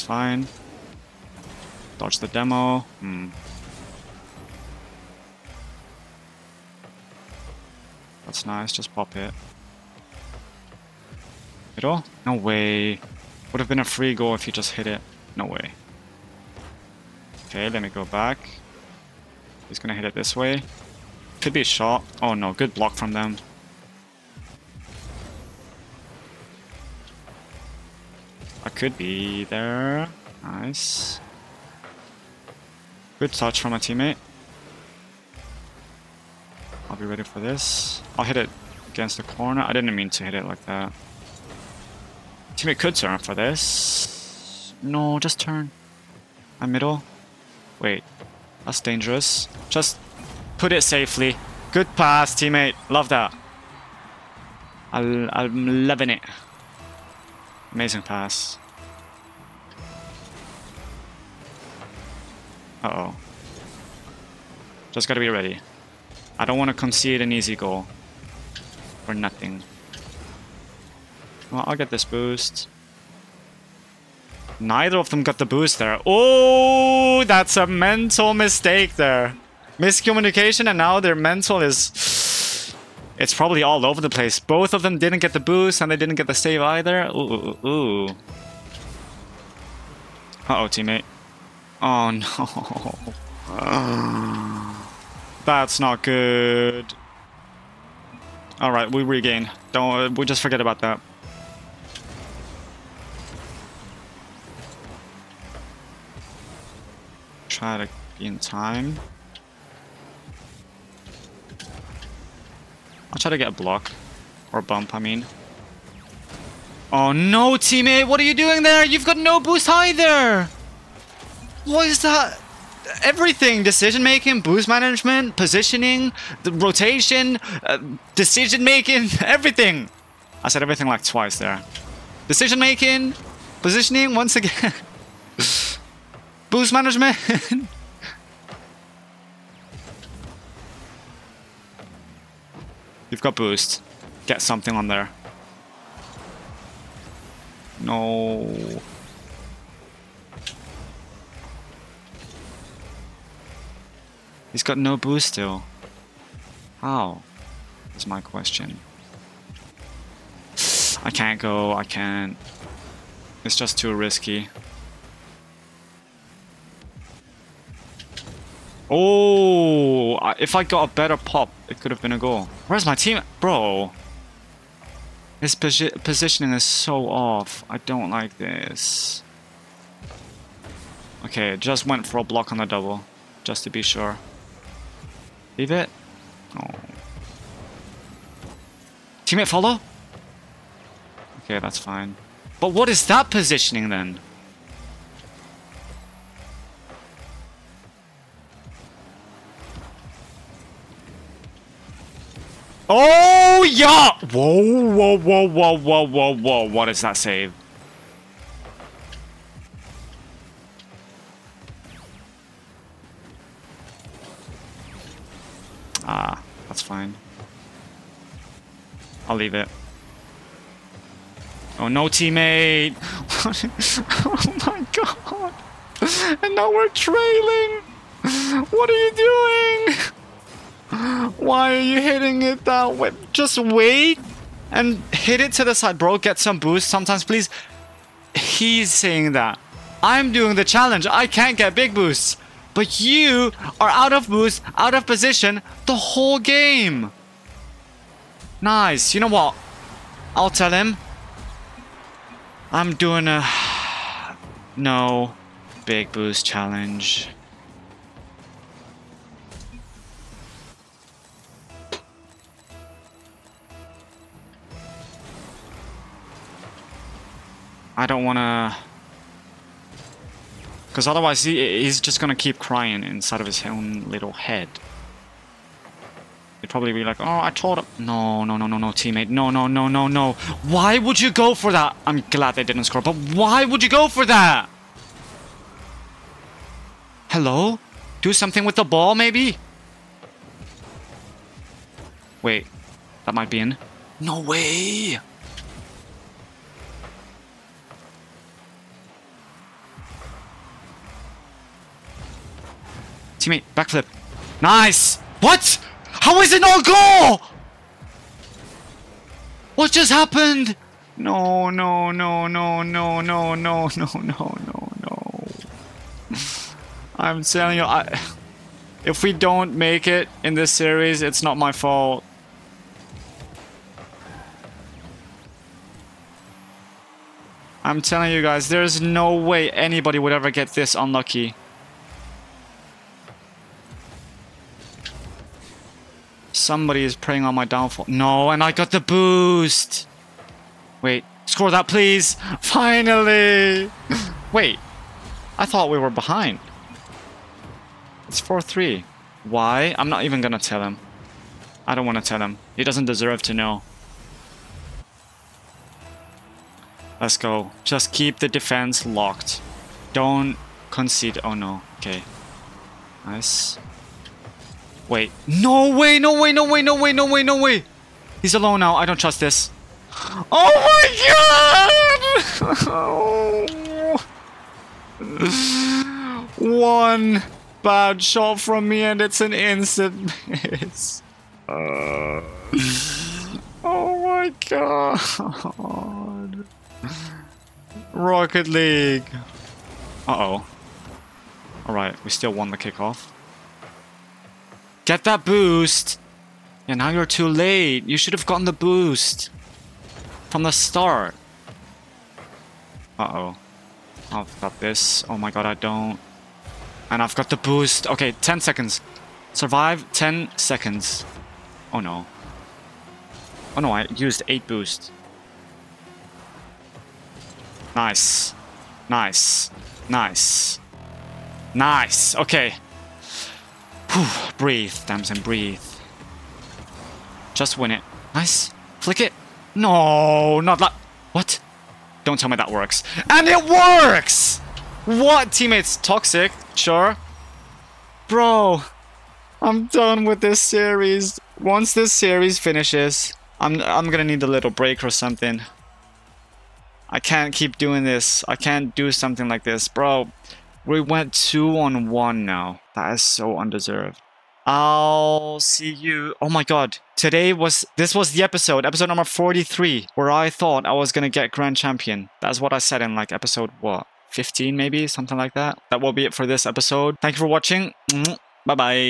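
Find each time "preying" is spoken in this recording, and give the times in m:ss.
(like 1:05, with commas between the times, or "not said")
5:37.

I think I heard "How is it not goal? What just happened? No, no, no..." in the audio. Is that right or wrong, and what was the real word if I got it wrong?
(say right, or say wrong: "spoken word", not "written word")
right.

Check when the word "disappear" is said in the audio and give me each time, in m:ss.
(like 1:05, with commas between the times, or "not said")
not said.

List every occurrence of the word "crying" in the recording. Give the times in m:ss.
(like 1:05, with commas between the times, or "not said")
4:32.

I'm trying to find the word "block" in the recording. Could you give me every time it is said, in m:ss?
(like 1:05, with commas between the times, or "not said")
0:22, 1:53, 3:02.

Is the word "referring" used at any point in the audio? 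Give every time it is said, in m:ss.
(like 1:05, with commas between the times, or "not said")
not said.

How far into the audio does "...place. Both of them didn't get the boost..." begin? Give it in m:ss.
1:24.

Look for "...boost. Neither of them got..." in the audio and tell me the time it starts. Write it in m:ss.
1:12.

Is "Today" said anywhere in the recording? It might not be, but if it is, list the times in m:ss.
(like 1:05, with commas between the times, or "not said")
7:37.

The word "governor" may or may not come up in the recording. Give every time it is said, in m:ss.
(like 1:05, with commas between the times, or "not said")
not said.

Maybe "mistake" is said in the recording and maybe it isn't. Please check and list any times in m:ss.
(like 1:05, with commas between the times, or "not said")
1:18.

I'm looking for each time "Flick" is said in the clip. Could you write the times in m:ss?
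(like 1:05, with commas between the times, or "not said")
7:08.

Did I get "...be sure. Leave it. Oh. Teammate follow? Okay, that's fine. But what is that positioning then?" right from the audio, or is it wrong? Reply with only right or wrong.
right.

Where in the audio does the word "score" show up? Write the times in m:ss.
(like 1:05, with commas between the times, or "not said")
4:42, 5:41.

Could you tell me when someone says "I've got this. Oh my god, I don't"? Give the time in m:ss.
6:44.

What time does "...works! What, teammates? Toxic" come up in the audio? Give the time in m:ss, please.
7:13.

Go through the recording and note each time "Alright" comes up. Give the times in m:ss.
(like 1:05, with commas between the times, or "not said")
1:38, 6:31.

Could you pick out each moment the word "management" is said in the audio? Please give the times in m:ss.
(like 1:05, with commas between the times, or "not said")
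2:04, 2:16.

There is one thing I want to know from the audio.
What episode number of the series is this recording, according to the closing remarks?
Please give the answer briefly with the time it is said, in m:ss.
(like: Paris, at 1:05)
43, at 7:38.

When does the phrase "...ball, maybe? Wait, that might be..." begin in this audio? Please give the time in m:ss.
4:48.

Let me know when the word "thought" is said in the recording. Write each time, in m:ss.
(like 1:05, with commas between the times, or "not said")
5:45, 7:40.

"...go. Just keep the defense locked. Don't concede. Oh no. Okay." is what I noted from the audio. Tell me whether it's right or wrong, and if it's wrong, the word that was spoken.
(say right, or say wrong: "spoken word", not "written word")
right.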